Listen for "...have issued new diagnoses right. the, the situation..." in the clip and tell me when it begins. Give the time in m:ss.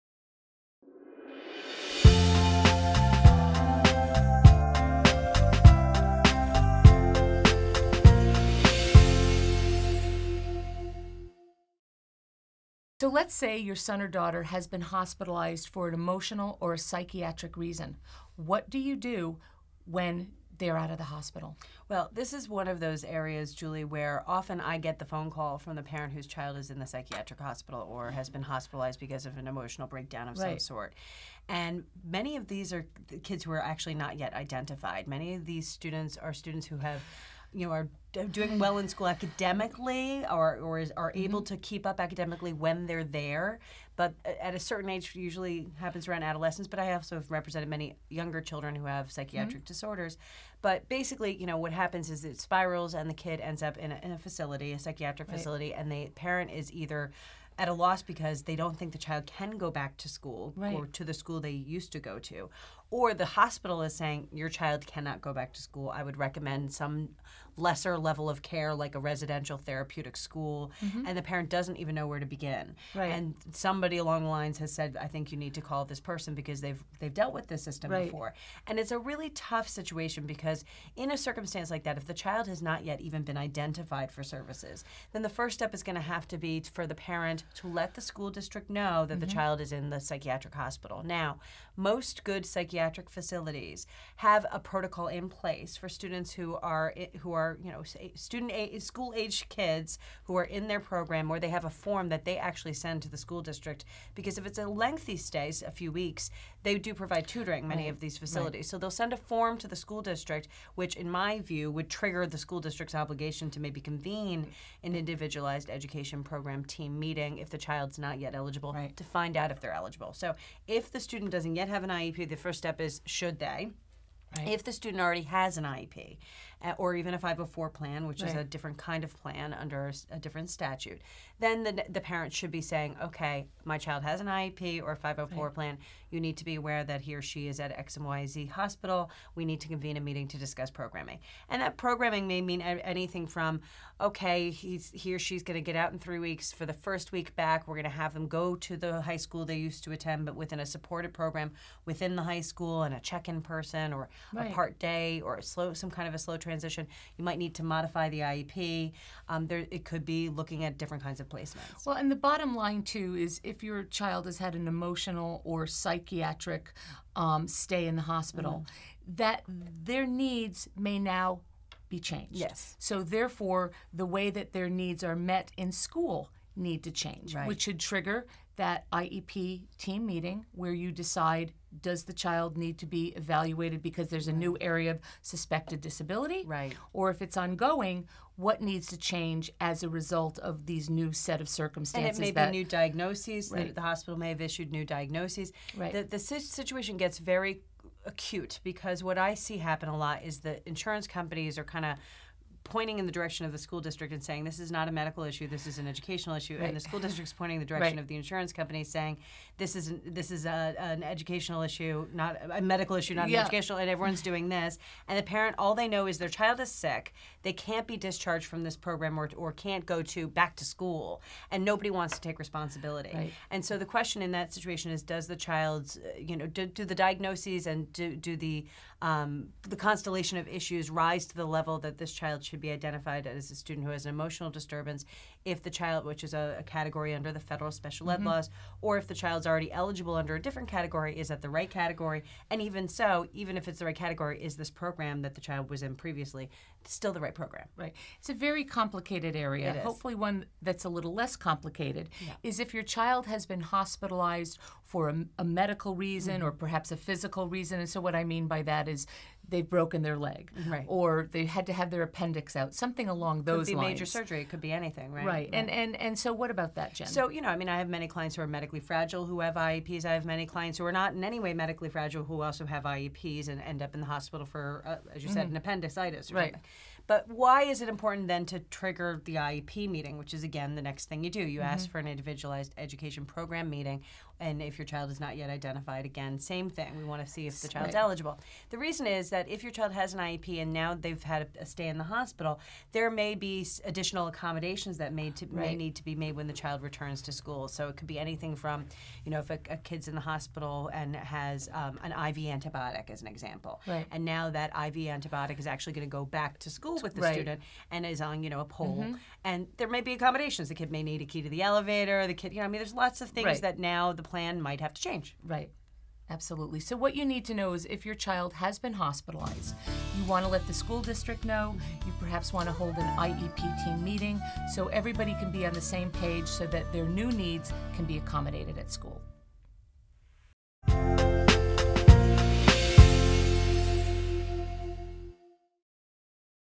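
3:14.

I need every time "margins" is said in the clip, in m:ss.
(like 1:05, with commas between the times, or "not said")
not said.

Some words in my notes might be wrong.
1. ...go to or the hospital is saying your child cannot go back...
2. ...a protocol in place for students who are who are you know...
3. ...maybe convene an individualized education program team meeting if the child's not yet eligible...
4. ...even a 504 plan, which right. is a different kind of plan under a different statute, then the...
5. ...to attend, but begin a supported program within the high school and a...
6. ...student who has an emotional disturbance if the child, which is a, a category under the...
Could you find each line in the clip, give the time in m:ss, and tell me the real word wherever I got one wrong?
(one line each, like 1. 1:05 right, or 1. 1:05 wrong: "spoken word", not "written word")
1. 1:01 right
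2. 1:34 right
3. 1:53 right
4. 2:06 right
5. 2:29 wrong: "within", not "begin"
6. 3:53 right.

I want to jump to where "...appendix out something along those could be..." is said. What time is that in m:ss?
4:22.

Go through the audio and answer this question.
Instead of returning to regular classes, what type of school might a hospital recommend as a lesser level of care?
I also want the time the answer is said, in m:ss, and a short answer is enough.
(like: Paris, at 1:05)
Residential therapeutic school, at 1:08.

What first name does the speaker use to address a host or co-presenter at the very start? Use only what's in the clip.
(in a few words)
Julie.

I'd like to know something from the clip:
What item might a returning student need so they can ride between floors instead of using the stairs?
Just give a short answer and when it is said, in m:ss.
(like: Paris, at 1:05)
Key to the elevator, at 5:11.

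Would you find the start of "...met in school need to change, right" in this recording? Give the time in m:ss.
2:55.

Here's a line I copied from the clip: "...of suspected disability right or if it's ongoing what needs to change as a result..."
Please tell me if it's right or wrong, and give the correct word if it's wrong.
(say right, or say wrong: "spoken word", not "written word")
right.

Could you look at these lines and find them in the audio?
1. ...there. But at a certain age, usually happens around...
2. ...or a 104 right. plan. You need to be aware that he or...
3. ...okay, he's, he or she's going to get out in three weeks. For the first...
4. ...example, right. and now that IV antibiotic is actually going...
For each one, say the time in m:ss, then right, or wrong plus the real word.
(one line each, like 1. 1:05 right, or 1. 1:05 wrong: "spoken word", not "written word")
1. 0:43 right
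2. 2:14 wrong: "504", not "104"
3. 2:23 right
4. 5:03 right.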